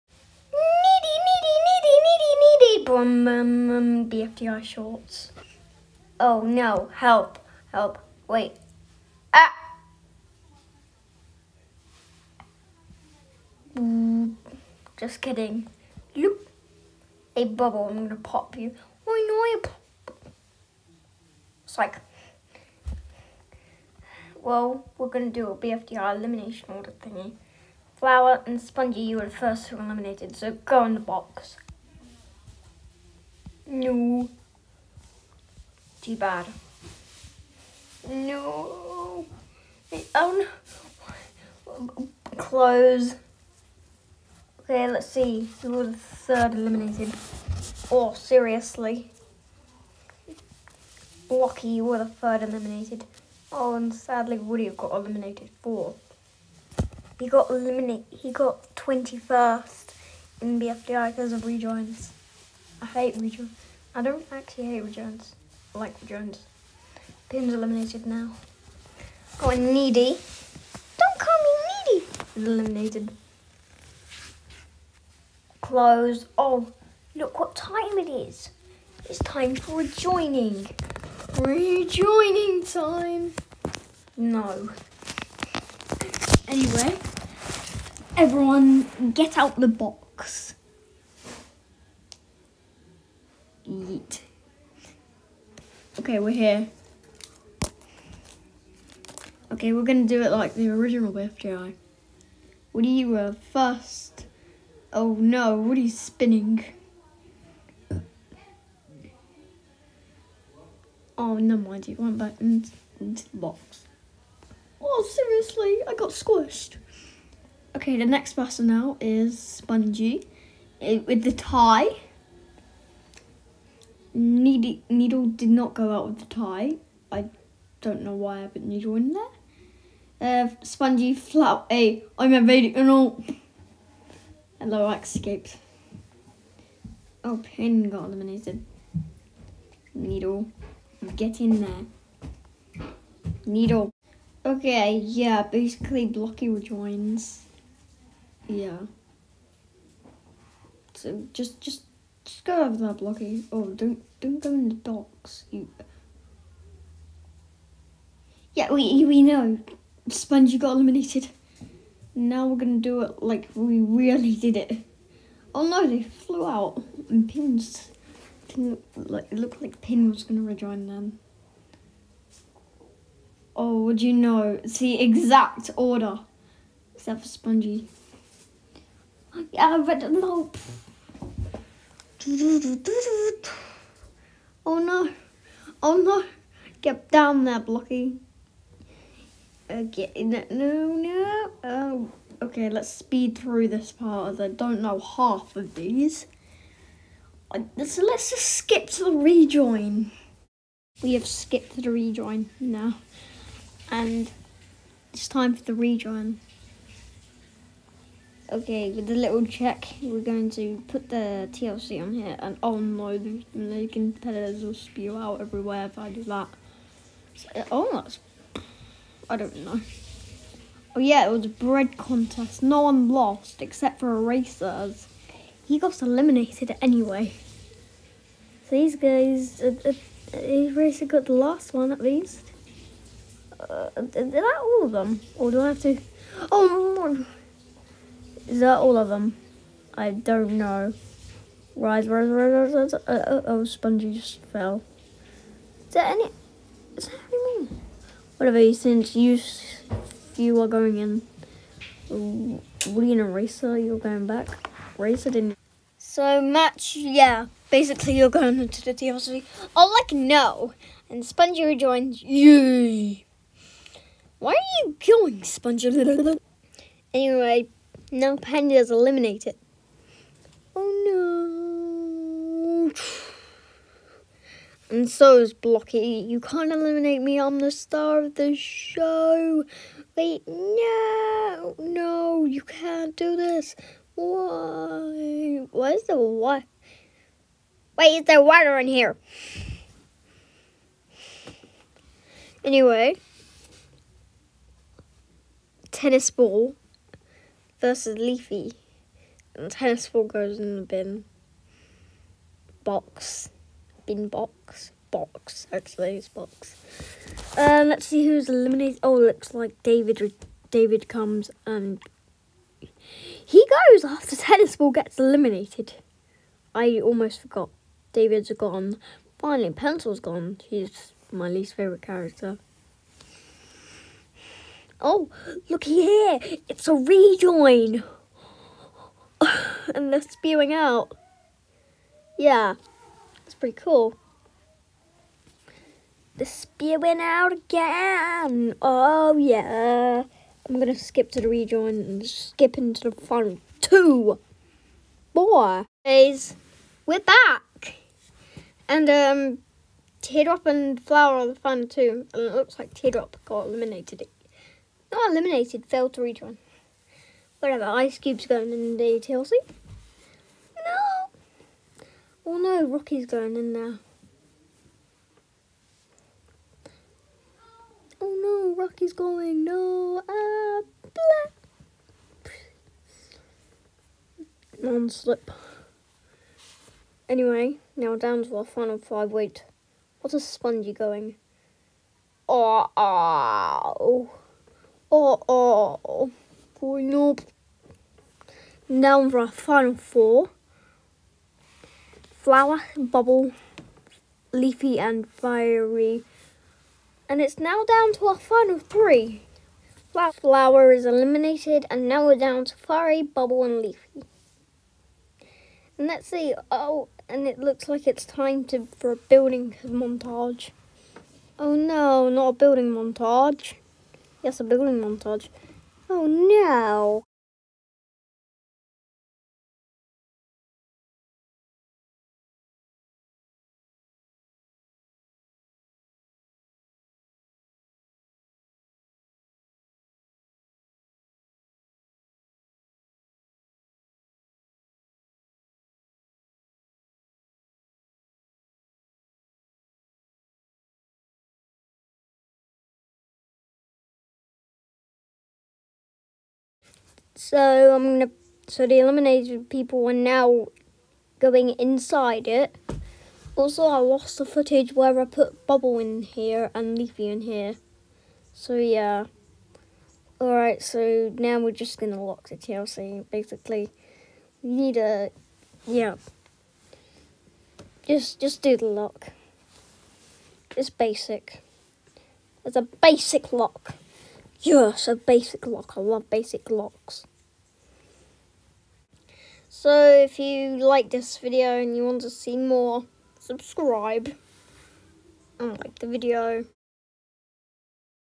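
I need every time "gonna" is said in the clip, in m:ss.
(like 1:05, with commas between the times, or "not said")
0:18, 0:25, 1:39, 2:42, 2:50, 7:28.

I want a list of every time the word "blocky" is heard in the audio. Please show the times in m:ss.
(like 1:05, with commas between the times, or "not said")
2:26, 2:32, 3:07, 4:35.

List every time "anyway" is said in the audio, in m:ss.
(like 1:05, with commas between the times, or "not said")
1:26, 3:46, 4:27, 4:52, 6:17.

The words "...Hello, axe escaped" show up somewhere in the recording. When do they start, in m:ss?
2:14.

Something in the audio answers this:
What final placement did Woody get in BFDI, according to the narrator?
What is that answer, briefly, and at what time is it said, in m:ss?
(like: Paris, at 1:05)
21st, at 0:58.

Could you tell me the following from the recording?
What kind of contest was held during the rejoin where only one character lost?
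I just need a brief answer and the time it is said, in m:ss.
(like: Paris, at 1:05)
A bread contest, at 3:41.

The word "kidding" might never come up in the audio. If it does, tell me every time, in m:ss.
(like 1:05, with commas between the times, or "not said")
0:15.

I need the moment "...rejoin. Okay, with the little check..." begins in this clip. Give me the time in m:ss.
3:25.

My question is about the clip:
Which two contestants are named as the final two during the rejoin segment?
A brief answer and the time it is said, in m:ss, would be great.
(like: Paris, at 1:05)
Teardrop and Flower, at 5:50.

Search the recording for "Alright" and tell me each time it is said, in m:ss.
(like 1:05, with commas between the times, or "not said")
7:40.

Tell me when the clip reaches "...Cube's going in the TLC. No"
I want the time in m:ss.
5:58.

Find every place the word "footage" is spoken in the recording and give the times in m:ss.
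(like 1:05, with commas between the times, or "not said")
7:34.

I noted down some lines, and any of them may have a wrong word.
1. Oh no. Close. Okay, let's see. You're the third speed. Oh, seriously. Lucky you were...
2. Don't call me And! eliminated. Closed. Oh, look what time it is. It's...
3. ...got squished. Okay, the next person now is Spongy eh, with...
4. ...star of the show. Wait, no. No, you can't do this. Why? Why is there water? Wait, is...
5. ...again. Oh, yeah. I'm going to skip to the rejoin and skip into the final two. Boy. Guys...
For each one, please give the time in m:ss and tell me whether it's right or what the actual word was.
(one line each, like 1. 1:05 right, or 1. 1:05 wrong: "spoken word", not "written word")
1. 0:40 wrong: "eliminated", not "speed"
2. 1:10 wrong: "Needy", not "And"
3. 1:55 right
4. 4:37 right
5. 5:37 right.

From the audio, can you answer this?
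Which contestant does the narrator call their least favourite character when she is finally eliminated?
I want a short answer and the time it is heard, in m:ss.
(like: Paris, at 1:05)
Pencil, at 5:19.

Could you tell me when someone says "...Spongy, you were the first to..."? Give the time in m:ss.
0:28.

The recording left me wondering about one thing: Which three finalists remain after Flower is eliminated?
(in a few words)
Firey, Bubble and Leafy.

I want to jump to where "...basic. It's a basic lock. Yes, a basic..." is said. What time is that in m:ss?
7:50.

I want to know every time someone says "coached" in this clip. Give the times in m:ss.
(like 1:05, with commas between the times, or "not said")
not said.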